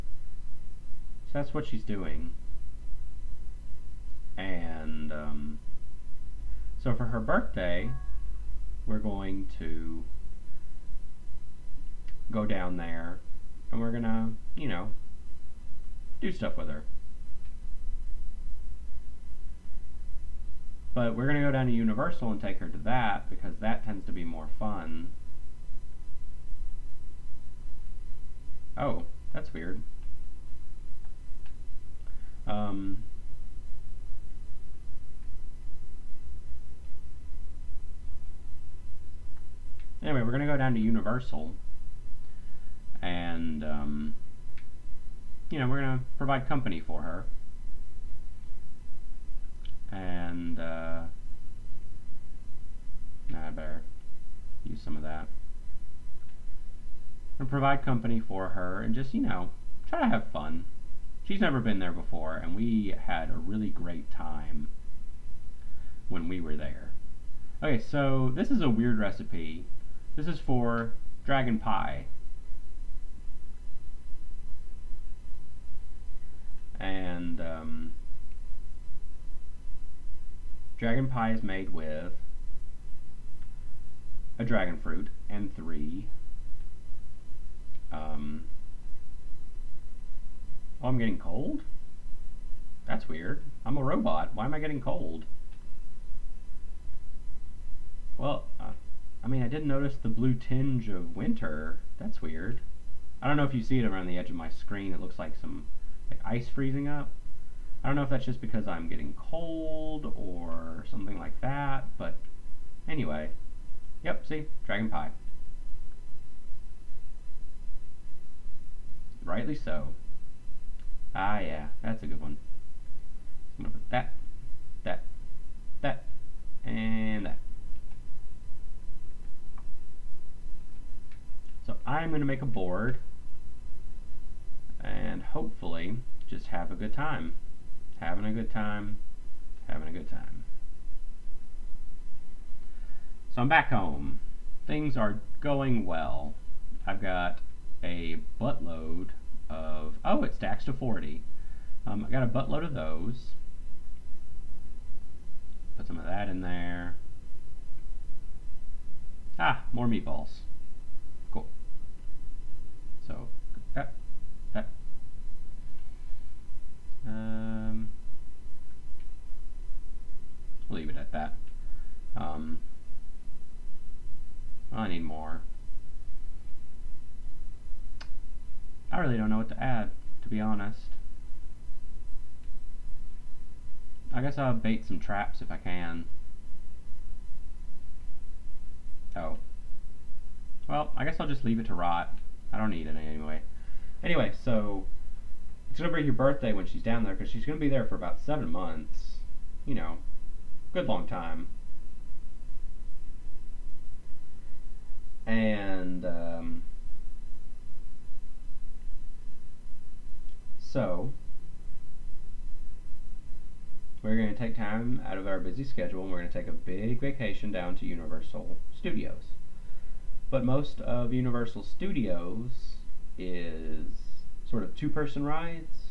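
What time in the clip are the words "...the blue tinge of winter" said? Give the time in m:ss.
1:40.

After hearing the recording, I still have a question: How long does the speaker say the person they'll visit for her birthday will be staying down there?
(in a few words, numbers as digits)
About seven months.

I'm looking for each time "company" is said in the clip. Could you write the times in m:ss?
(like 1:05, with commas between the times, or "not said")
0:46, 0:57.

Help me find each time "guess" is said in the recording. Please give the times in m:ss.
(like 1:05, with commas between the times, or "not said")
3:04, 3:11.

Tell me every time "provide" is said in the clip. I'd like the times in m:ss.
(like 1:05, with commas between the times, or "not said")
0:46, 0:57.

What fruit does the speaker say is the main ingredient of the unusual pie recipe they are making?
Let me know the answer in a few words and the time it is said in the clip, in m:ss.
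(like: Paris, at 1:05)
Dragon fruit, at 1:24.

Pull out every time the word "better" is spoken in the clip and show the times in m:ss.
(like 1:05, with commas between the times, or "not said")
0:53.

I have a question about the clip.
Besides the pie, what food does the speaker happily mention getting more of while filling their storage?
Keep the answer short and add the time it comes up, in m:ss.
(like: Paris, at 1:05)
Meatballs, at 2:39.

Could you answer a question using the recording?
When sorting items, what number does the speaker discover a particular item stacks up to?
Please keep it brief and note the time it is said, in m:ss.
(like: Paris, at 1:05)
40, at 2:30.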